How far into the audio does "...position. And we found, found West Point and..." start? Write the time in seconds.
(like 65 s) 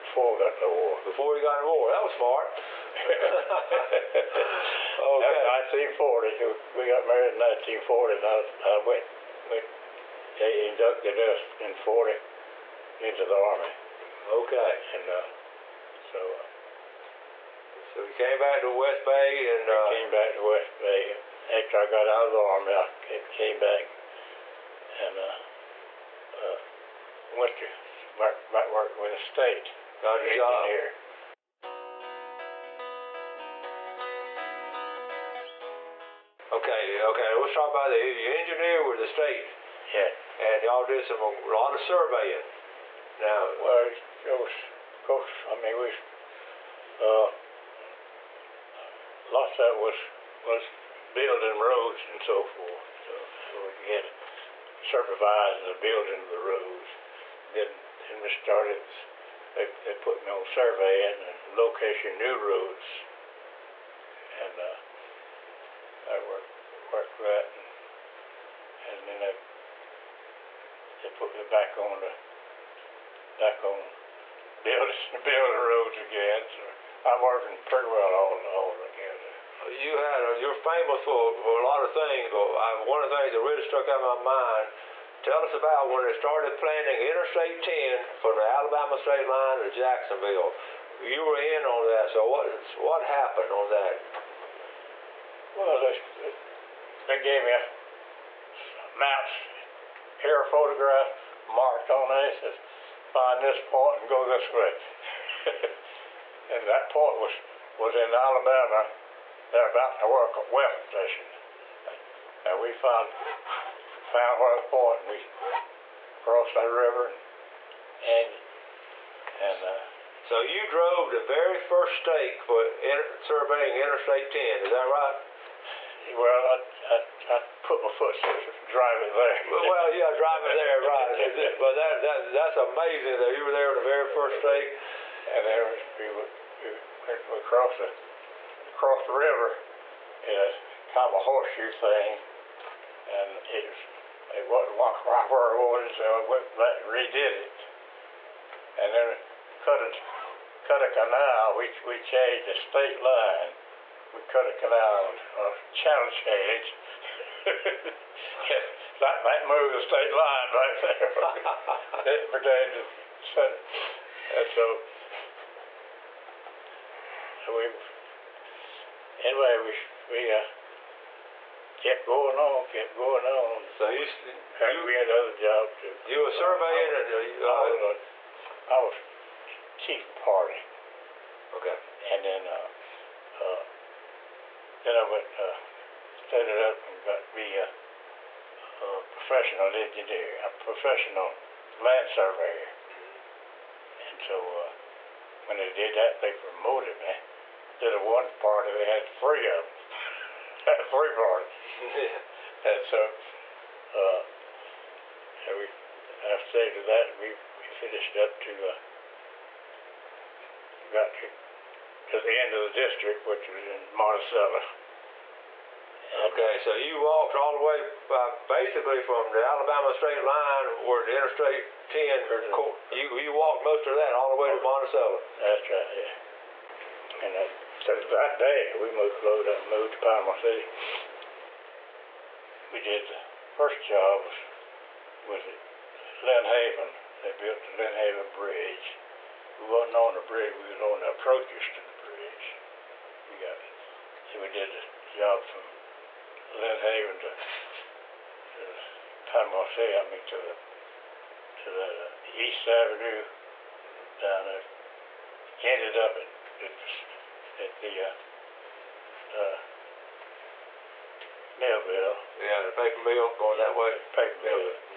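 110 s.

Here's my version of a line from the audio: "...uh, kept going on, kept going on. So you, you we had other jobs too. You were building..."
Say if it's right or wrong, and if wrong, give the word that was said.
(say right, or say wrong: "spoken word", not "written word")
wrong: "surveying", not "building".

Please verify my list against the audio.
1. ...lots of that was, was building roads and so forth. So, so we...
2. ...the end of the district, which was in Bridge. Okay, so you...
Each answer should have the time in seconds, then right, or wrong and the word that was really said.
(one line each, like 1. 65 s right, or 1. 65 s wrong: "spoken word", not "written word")
1. 49 s right
2. 212 s wrong: "Monticello", not "Bridge".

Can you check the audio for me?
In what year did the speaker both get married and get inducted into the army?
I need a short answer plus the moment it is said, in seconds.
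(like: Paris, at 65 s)
1940, at 6 s.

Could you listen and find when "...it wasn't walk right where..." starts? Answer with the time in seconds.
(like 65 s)
144 s.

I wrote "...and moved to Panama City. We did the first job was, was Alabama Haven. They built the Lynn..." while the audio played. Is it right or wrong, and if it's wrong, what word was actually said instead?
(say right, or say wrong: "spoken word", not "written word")
wrong: "Lynn", not "Alabama".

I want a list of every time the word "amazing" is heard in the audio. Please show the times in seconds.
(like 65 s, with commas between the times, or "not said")
132 s.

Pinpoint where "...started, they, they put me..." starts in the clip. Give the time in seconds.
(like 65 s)
58 s.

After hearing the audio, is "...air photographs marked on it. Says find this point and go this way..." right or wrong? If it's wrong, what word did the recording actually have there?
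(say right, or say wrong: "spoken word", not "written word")
right.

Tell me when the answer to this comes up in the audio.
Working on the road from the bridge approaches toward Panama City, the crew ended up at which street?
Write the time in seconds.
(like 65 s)
252 s.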